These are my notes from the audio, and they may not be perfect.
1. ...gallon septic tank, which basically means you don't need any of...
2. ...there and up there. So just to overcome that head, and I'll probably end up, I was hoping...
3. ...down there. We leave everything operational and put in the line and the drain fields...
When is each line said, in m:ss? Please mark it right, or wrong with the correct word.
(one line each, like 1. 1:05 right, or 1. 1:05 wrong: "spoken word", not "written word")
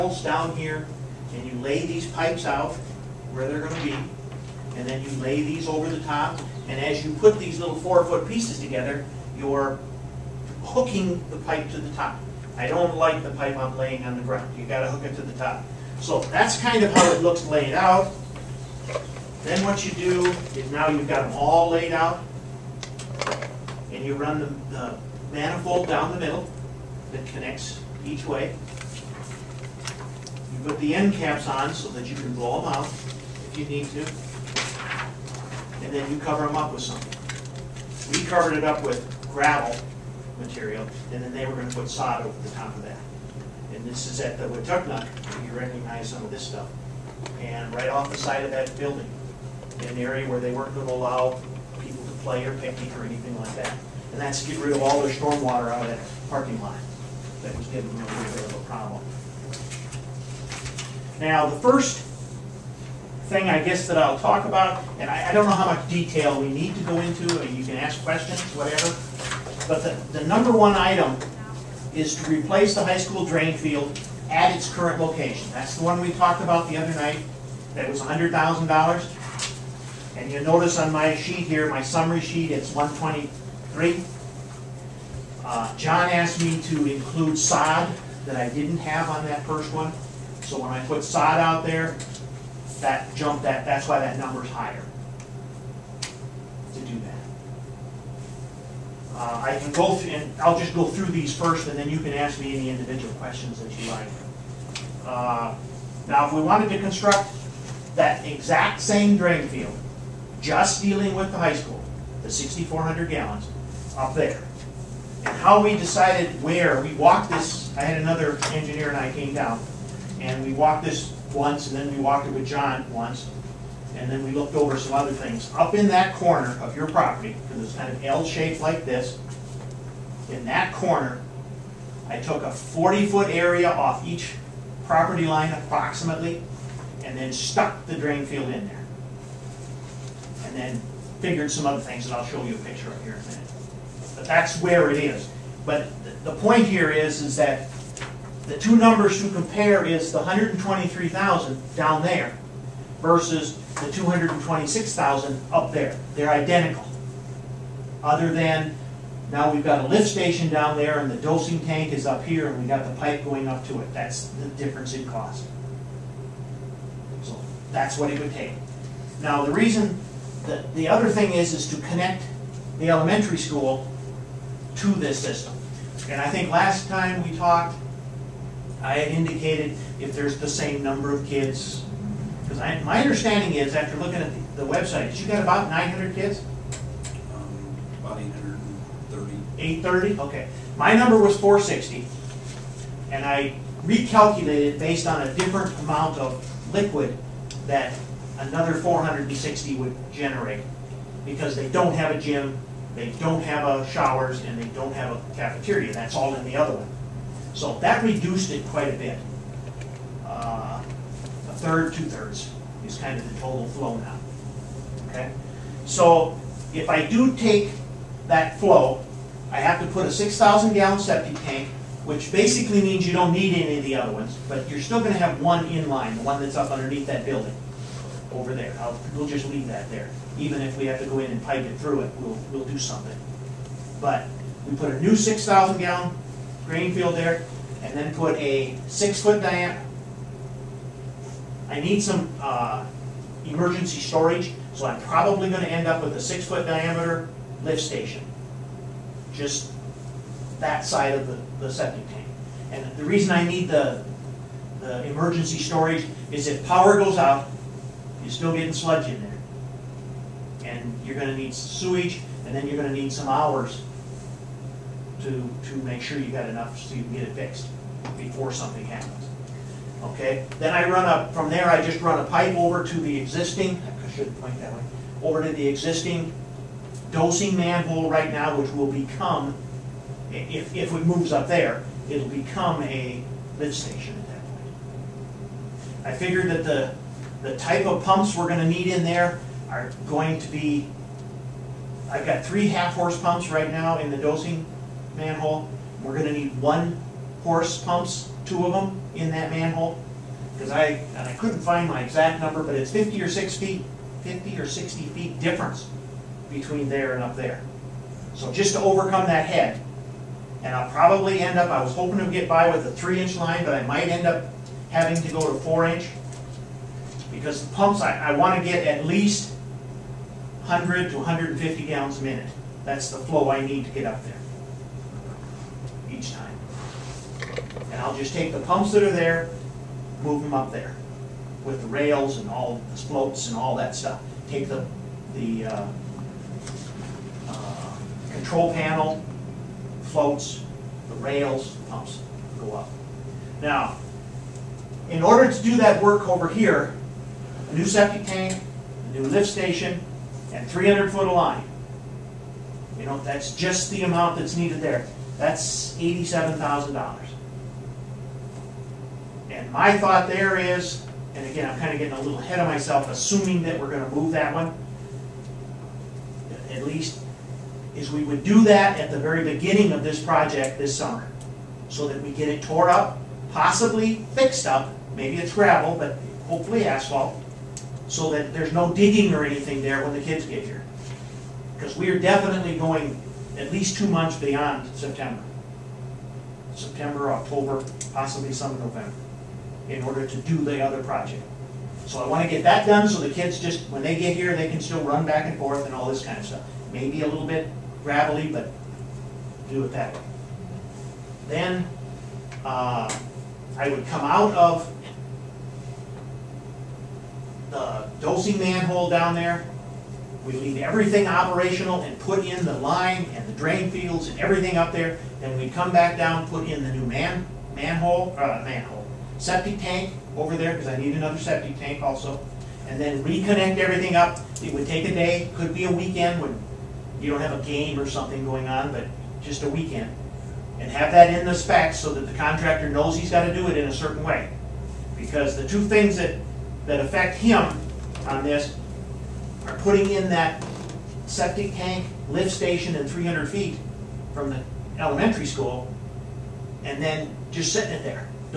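1. 3:40 right
2. 5:06 right
3. 6:49 right.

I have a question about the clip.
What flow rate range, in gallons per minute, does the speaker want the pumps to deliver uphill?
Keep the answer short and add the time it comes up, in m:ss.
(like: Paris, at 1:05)
100 to 150, at 5:20.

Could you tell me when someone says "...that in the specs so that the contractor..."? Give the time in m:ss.
7:11.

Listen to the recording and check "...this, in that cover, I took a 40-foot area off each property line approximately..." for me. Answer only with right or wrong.
wrong.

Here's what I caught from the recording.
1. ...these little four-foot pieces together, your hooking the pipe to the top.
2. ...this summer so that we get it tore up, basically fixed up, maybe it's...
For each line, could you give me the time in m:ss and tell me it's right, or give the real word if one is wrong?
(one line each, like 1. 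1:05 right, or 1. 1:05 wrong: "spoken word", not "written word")
1. 0:07 right
2. 6:10 wrong: "possibly", not "basically".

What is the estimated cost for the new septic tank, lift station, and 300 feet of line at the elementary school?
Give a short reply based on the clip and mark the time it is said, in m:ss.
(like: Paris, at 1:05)
$87,000, at 5:55.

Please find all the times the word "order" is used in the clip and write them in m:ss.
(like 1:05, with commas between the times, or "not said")
5:45, 6:30.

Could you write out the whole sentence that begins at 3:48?
I'll, we'll just leave that there.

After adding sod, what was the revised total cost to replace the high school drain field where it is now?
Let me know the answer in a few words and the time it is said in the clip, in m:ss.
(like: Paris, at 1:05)
123, at 1:22.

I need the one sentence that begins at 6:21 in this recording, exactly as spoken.
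Because we are definitely going at least two months beyond September.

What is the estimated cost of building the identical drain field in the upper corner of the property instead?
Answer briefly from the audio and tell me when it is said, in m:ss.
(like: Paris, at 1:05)
226,000, at 2:33.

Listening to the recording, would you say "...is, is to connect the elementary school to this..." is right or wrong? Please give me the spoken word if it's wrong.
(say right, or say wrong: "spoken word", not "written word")
right.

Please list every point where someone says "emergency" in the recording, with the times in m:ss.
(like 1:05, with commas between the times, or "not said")
4:03, 4:15.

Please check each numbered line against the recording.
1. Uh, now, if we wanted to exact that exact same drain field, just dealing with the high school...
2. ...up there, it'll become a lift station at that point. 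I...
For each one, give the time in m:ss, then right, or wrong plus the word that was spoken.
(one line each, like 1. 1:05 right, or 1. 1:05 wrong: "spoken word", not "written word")
1. 1:45 wrong: "construct", not "exact"
2. 4:41 right.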